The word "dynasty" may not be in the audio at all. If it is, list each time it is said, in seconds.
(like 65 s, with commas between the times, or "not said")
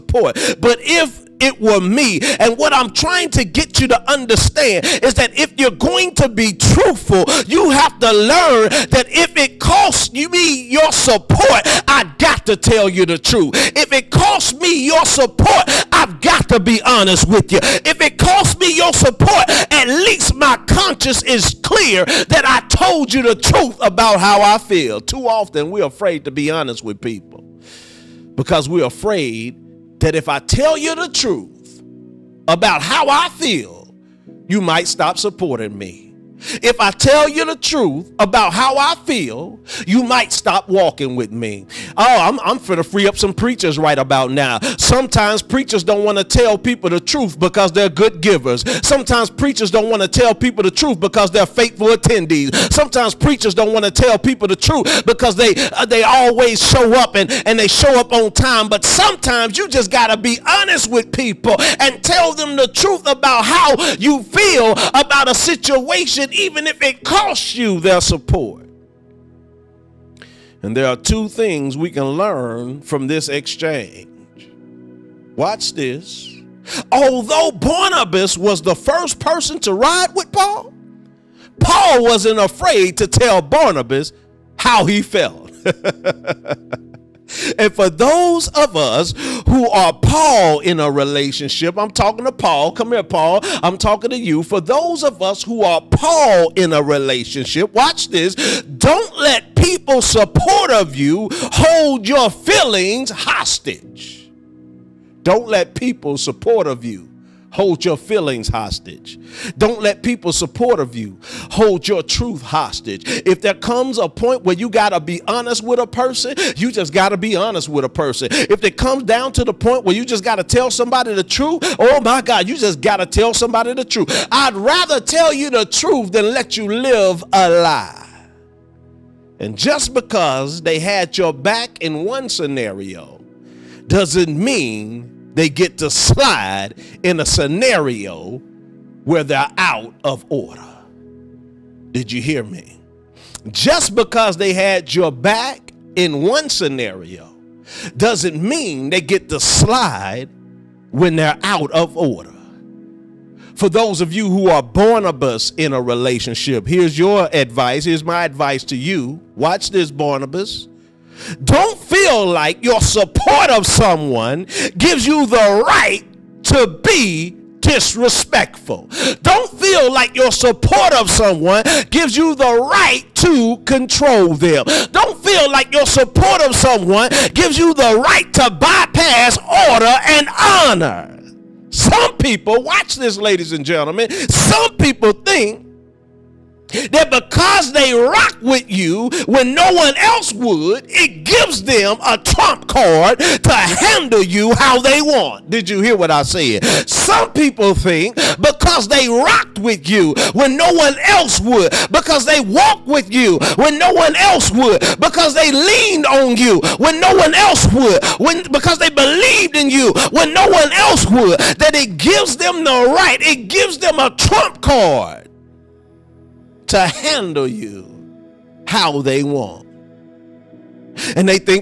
not said.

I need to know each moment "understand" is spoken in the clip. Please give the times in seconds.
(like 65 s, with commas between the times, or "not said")
4 s.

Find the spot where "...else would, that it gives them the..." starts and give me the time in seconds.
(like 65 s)
210 s.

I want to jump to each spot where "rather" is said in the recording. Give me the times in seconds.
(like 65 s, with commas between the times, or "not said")
124 s.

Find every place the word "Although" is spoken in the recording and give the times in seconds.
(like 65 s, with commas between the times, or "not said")
76 s.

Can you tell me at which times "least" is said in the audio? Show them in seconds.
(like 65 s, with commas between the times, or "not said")
19 s.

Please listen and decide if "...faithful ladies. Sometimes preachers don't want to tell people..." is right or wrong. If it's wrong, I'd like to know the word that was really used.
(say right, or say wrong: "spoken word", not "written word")
wrong: "attendees", not "ladies".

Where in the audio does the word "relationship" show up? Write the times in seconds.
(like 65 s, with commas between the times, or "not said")
90 s, 96 s, 155 s.